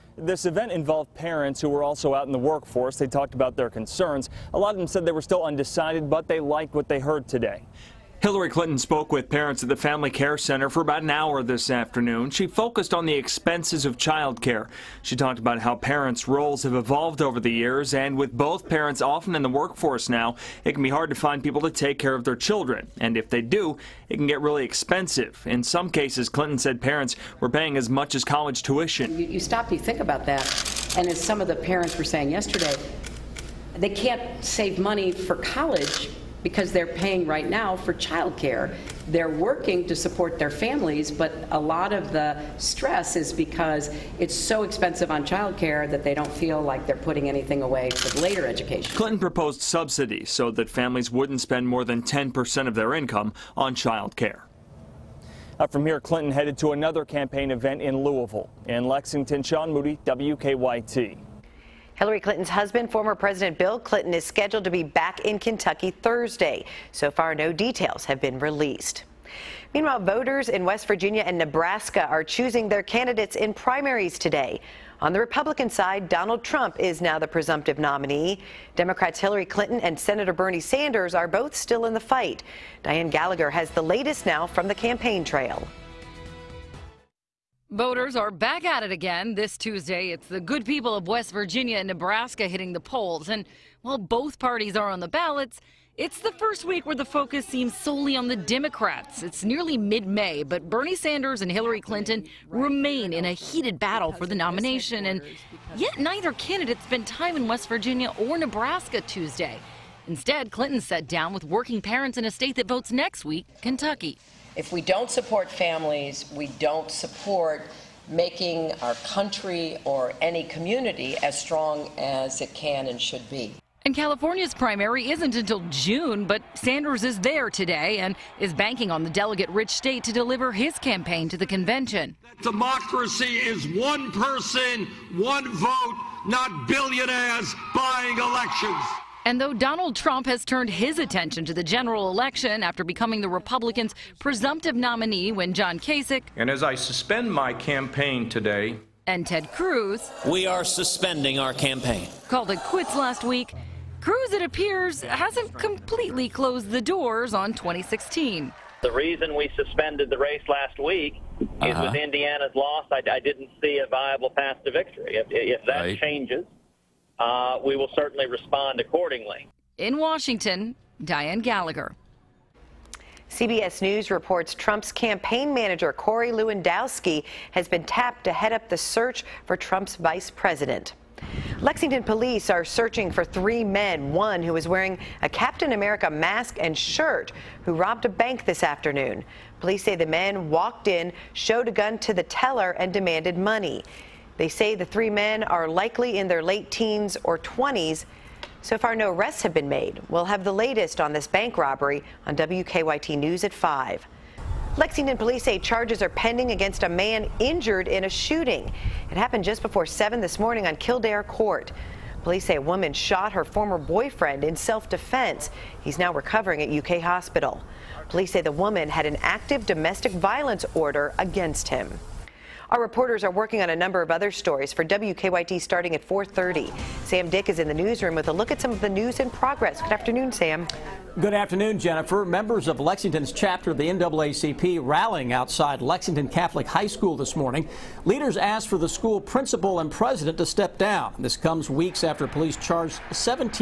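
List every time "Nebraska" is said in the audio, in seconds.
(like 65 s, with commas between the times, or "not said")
71 s, 91 s, 108 s.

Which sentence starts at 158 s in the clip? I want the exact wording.
The reason we suspended the race last week uh-huh.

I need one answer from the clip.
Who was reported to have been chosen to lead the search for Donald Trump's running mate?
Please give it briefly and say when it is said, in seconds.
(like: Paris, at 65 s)
Corey Lewandowski, at 175 s.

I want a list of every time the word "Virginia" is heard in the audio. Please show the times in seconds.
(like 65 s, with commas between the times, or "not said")
70 s, 91 s, 107 s.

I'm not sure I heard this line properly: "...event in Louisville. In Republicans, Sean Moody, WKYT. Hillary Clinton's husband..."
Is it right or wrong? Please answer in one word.
wrong.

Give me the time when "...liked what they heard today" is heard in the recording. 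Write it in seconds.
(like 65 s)
6 s.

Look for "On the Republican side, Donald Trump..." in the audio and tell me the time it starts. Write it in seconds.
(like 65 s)
75 s.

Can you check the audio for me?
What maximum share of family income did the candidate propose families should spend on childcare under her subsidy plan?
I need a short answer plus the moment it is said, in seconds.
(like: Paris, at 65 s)
10%, at 52 s.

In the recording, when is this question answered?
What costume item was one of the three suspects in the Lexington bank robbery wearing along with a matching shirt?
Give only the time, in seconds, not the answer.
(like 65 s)
185 s.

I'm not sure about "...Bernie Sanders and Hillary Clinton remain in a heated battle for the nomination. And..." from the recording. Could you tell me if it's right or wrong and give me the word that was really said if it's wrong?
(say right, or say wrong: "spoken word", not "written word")
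right.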